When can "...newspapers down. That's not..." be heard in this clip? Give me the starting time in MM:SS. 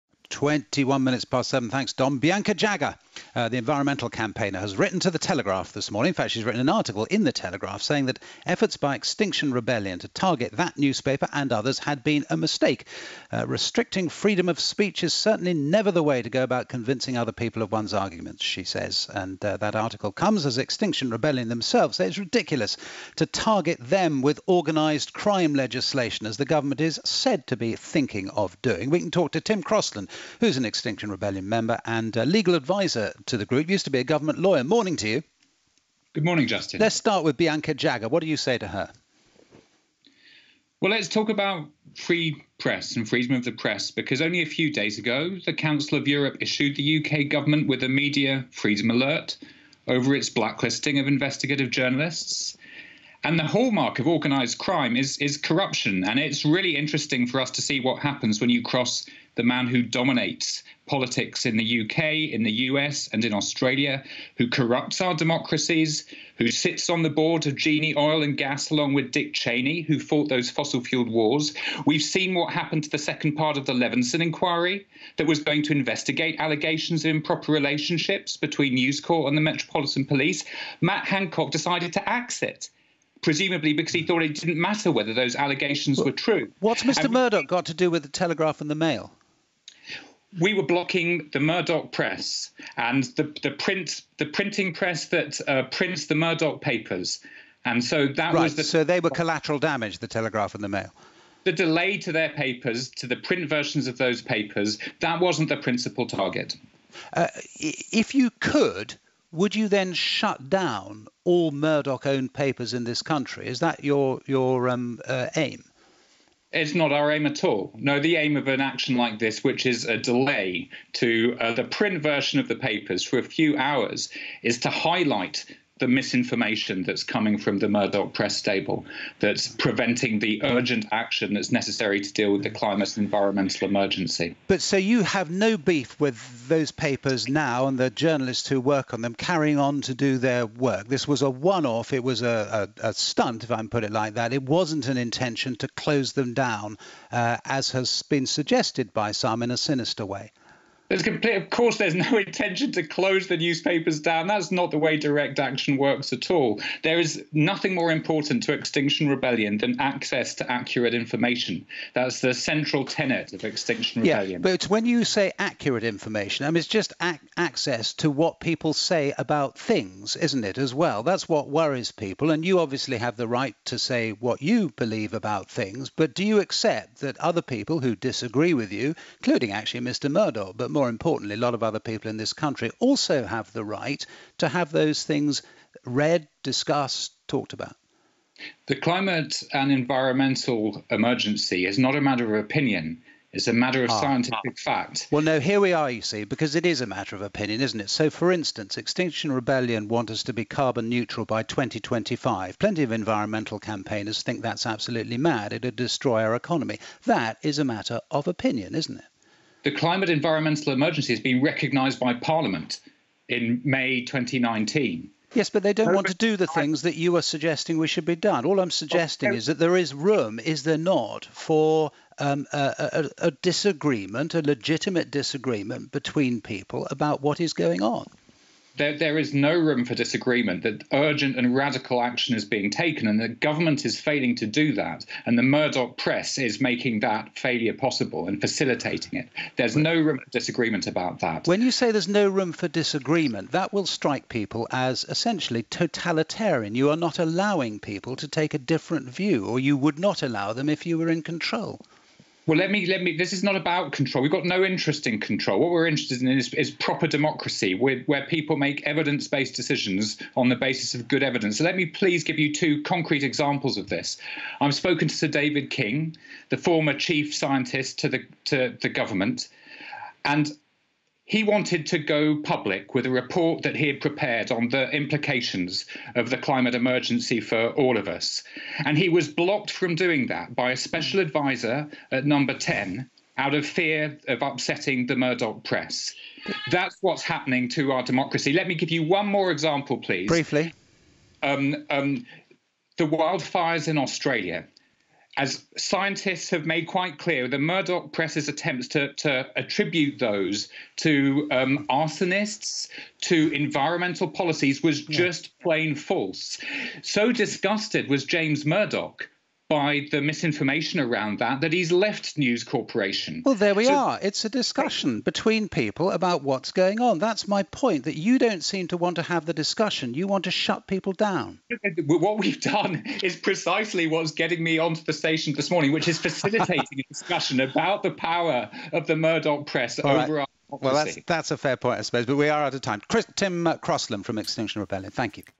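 02:33.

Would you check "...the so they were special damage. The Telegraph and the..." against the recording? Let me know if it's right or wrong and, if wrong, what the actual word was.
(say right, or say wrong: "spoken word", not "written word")
wrong: "collateral", not "special".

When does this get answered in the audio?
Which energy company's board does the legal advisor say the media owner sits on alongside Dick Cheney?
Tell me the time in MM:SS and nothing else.
01:07.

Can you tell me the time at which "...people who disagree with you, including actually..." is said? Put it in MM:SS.
02:57.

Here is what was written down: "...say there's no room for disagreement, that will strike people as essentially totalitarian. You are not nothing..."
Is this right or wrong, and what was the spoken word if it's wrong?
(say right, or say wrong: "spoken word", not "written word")
wrong: "allowing", not "nothing".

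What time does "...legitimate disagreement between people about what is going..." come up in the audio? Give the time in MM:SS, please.
03:44.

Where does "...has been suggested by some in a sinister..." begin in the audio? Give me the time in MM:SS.
02:27.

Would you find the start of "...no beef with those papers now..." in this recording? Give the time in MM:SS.
02:15.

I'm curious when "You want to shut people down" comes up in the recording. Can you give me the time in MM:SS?
05:20.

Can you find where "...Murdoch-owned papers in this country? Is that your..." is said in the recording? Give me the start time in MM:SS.
01:51.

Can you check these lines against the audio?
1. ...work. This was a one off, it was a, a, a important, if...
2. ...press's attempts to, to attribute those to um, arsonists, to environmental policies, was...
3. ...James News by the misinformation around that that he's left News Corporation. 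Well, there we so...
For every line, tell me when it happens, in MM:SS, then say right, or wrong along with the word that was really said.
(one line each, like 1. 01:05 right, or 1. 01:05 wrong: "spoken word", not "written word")
1. 02:20 wrong: "stunt", not "important"
2. 04:58 right
3. 05:08 wrong: "Murdoch", not "News".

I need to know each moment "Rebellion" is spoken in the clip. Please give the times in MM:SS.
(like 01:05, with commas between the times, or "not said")
00:09, 00:21, 00:31, 02:39, 02:44, 03:19, 05:34.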